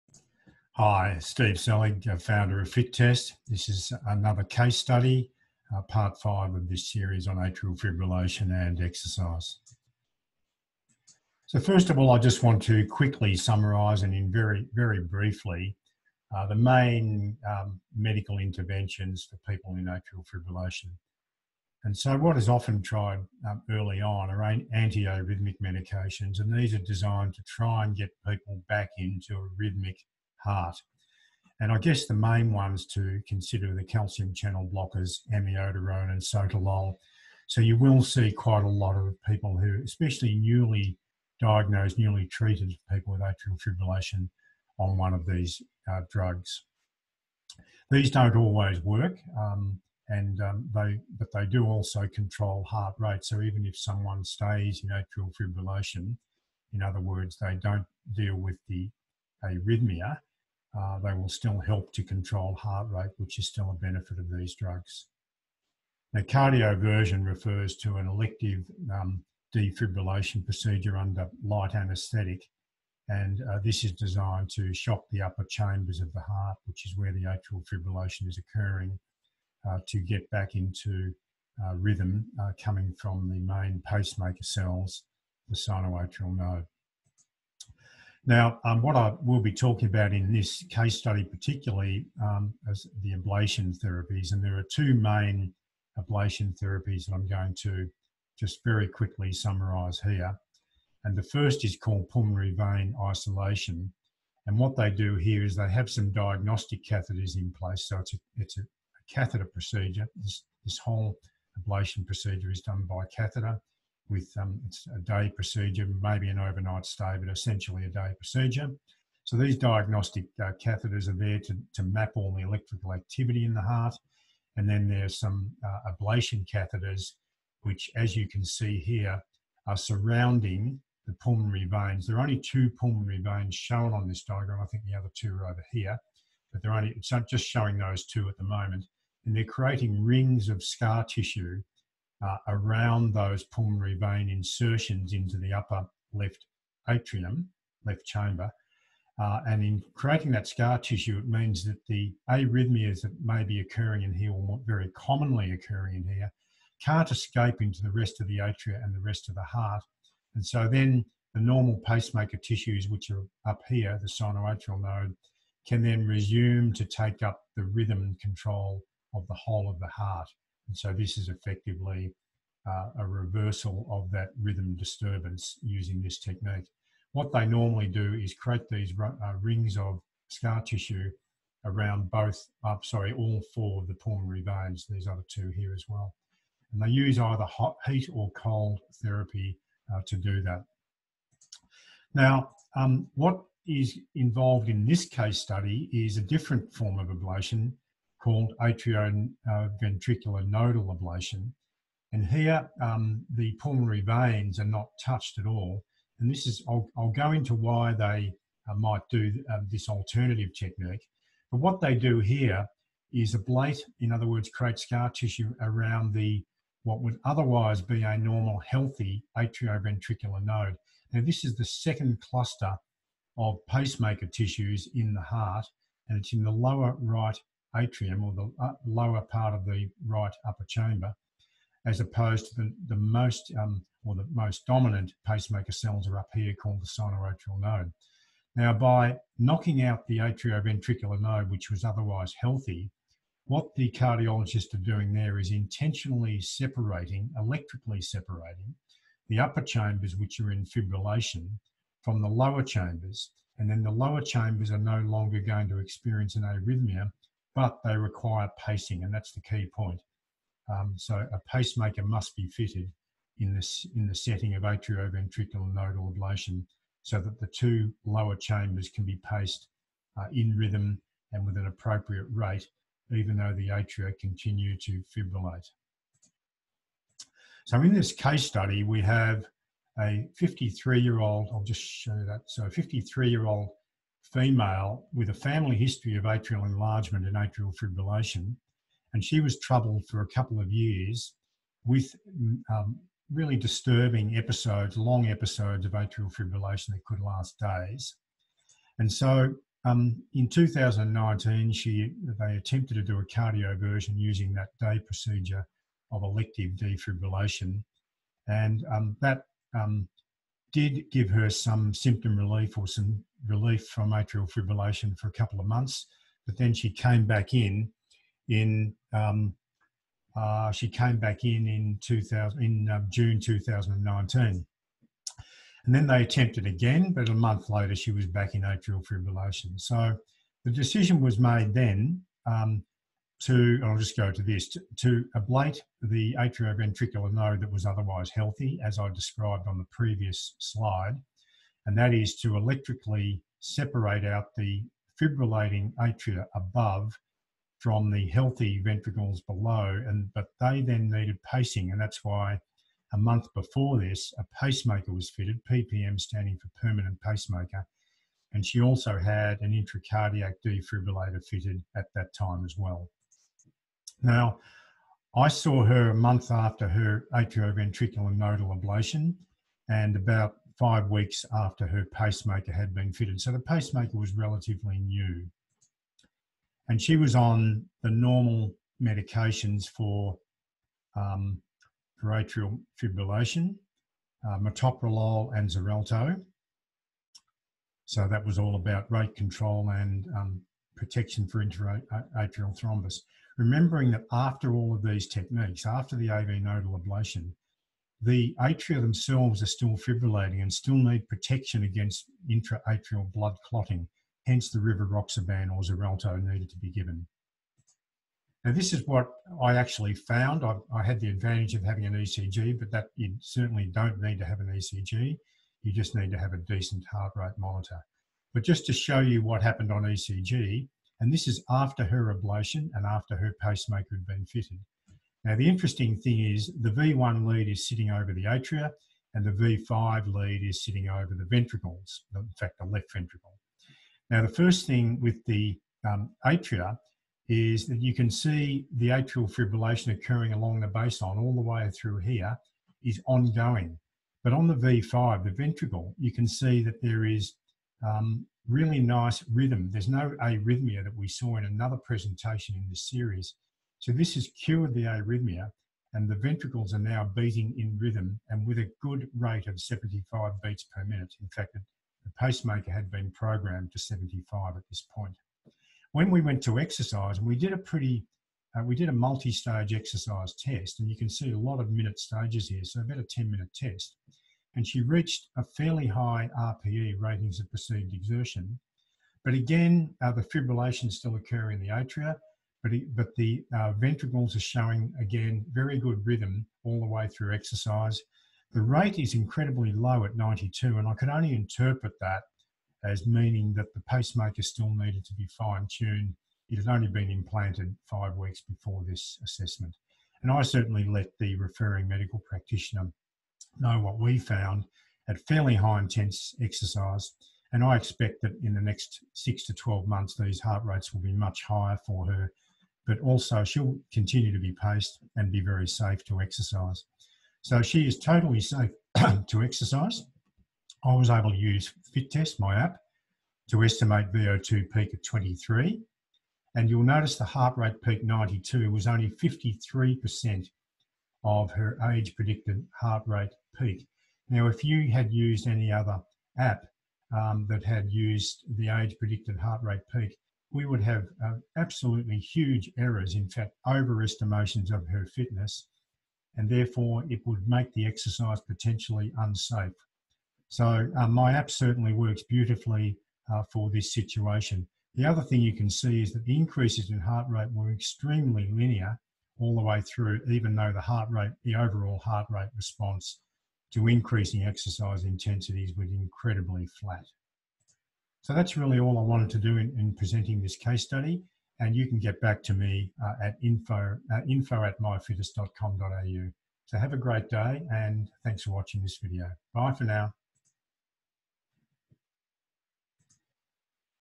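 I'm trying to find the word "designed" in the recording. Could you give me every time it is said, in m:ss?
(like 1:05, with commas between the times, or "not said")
0:26, 1:13.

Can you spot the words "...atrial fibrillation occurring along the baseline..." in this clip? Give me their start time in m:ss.
7:19.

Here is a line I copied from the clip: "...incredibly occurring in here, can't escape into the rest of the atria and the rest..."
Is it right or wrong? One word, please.
wrong.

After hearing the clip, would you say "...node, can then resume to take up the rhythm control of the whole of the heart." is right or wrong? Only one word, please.
right.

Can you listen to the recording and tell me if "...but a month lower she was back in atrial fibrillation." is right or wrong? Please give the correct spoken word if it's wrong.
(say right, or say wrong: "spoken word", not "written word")
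wrong: "later", not "lower".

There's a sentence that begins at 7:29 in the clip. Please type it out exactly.
There's no arrhythmia that we saw in another presentation in this series.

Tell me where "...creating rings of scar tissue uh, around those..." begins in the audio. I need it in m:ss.
2:19.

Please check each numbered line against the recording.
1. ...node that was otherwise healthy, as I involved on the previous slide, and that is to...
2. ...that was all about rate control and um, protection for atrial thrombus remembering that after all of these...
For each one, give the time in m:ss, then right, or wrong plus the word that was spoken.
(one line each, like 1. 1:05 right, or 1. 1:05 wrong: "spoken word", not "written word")
1. 5:37 wrong: "described", not "involved"
2. 6:28 right.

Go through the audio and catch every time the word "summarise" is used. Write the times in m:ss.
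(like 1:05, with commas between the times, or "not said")
0:13, 1:39.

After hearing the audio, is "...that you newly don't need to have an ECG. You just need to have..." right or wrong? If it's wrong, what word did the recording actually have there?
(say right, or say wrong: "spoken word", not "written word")
wrong: "certainly", not "newly".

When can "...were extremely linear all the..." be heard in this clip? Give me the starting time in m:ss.
9:17.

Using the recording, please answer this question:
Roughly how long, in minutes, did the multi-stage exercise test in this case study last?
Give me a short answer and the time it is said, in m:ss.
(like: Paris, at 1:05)
10 minutes, at 7:53.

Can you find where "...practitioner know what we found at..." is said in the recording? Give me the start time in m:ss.
8:22.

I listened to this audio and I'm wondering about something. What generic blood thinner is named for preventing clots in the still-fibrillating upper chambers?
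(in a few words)
Rivaroxaban.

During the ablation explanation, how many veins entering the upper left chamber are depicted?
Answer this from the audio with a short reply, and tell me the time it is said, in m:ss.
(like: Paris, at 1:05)
2, at 2:12.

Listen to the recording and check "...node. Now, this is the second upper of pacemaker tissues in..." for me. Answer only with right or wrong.
wrong.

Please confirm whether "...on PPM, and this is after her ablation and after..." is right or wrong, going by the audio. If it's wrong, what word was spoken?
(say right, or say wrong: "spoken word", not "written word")
wrong: "ECG", not "PPM".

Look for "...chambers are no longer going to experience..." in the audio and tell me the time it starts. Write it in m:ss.
4:14.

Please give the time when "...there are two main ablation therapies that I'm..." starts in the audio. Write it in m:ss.
1:34.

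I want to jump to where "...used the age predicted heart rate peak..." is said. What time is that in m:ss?
8:58.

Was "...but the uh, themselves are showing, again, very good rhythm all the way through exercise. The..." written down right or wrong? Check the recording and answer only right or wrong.
wrong.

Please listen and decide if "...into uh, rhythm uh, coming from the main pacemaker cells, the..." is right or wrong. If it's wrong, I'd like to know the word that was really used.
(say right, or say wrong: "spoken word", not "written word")
right.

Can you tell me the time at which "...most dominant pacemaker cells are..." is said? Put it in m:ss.
3:54.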